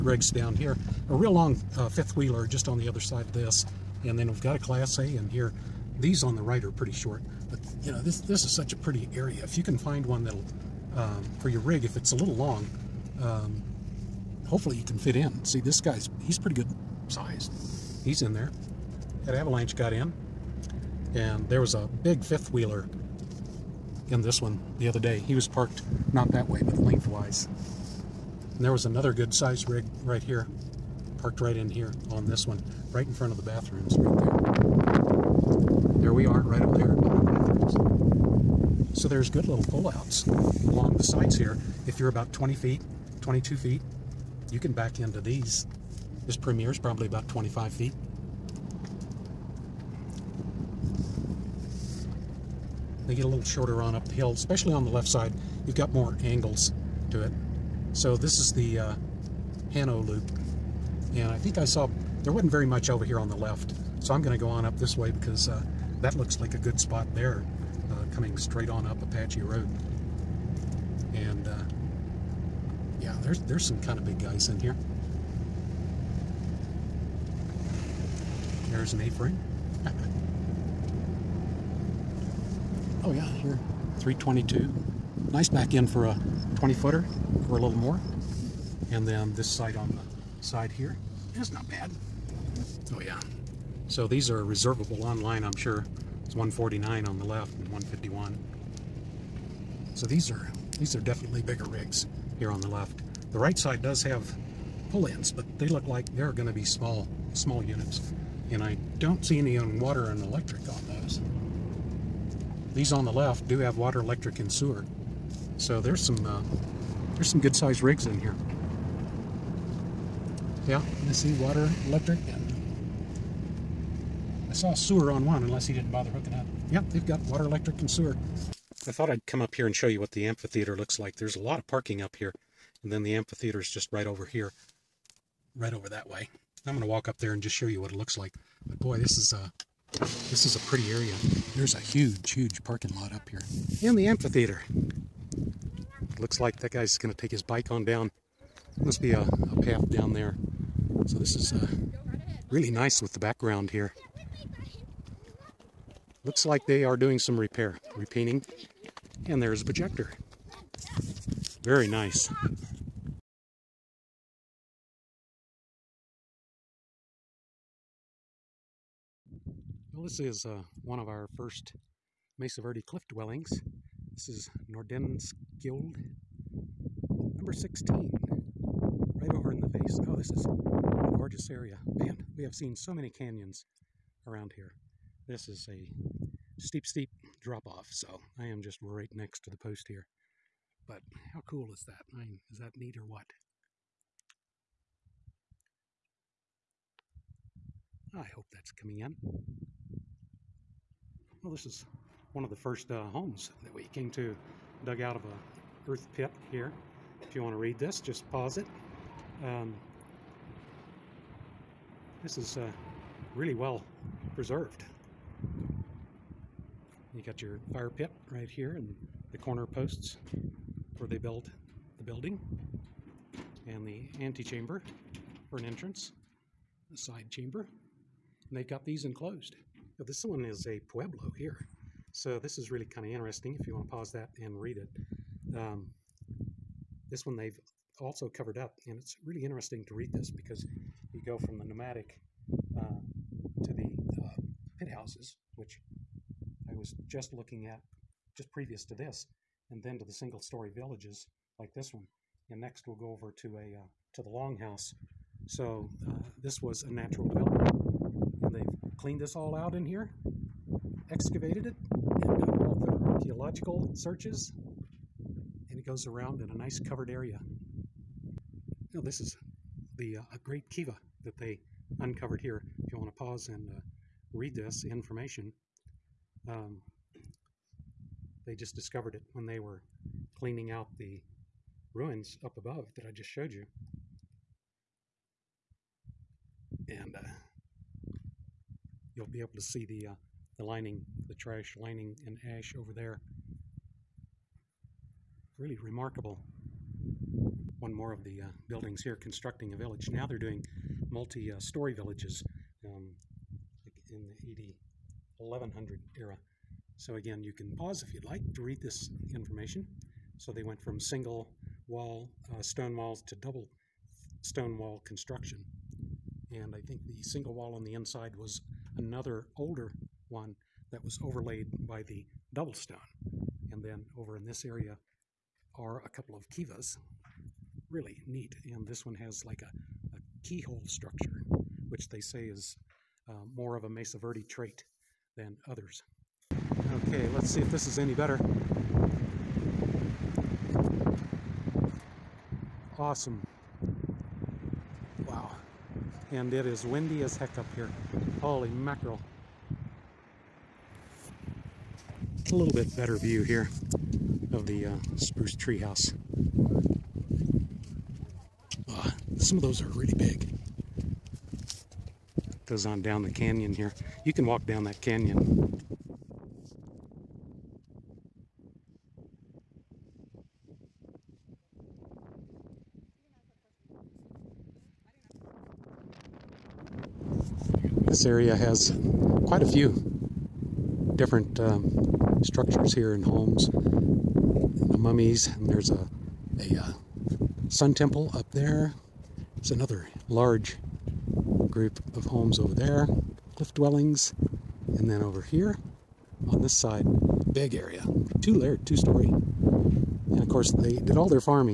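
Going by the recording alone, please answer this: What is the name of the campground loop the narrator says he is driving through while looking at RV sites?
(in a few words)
Hano loop.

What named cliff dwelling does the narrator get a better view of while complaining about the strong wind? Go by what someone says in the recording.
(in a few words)
Spruce Tree House.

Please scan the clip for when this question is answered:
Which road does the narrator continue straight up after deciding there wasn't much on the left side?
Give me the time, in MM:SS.
01:08.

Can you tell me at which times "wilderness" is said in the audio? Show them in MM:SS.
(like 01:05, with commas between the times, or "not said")
not said.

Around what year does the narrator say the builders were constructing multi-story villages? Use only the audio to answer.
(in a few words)
AD 1100.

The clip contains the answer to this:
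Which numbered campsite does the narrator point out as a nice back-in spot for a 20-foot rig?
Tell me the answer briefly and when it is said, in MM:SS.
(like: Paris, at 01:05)
322, at 01:23.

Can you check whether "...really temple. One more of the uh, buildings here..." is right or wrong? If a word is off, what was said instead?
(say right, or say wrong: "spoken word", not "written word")
wrong: "remarkable", not "temple".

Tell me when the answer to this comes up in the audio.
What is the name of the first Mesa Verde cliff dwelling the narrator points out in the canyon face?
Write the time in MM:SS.
02:54.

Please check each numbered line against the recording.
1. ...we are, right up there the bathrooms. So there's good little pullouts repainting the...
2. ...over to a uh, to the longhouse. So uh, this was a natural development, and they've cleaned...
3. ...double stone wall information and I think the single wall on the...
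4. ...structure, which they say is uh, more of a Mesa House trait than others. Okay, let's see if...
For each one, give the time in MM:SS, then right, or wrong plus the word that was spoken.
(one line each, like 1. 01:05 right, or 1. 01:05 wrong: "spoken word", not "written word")
1. 00:36 wrong: "along", not "repainting"
2. 04:13 right
3. 05:13 wrong: "construction", not "information"
4. 05:30 wrong: "Verde", not "House".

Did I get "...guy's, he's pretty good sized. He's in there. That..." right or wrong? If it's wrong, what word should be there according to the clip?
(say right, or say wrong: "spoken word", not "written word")
right.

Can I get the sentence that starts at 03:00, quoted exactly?
Oh, this is a gorgeous area.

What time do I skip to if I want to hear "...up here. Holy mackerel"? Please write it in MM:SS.
05:47.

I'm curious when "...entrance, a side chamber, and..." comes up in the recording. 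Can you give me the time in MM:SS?
03:45.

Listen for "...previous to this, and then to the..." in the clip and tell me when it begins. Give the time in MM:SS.
04:08.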